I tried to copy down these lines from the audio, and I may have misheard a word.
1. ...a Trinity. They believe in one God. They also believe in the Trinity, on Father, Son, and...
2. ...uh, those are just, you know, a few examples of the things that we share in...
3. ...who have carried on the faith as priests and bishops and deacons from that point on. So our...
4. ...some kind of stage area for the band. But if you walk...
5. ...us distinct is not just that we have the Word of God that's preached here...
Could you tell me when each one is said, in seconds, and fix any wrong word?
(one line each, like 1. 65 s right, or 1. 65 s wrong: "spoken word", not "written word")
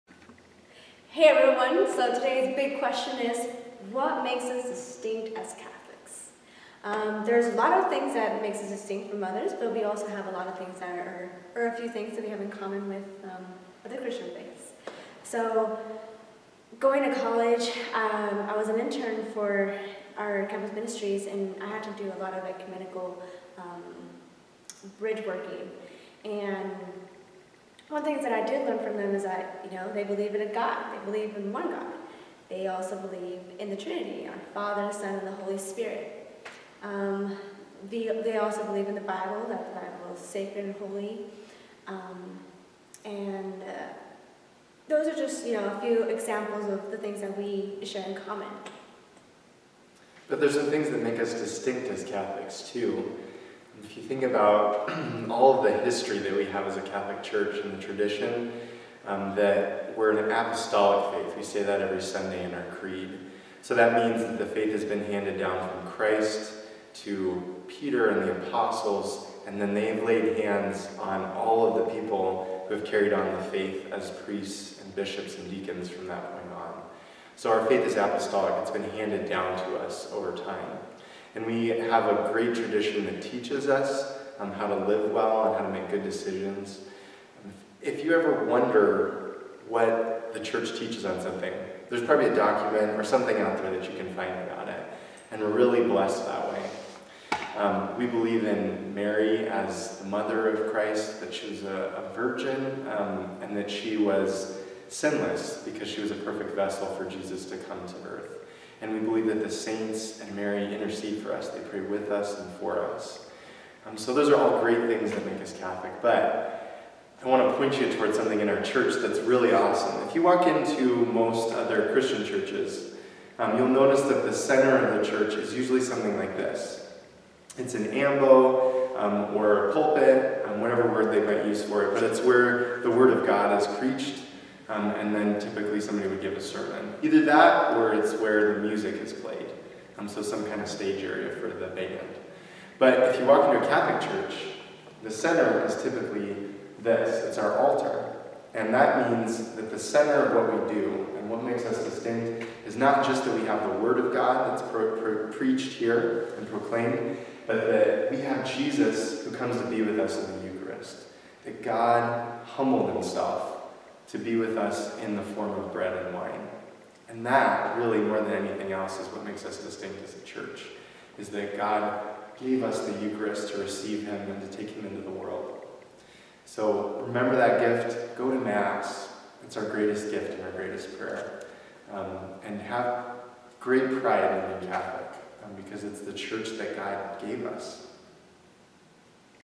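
1. 30 s wrong: "God", not "Trinity"
2. 43 s right
3. 72 s right
4. 140 s right
5. 151 s right.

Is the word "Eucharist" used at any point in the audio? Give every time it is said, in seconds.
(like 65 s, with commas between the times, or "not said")
160 s, 173 s.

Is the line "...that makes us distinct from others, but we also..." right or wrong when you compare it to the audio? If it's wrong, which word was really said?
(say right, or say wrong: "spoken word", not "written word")
right.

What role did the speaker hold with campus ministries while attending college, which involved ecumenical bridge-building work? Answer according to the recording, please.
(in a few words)
Intern.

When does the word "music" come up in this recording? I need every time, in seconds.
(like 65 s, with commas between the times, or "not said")
138 s.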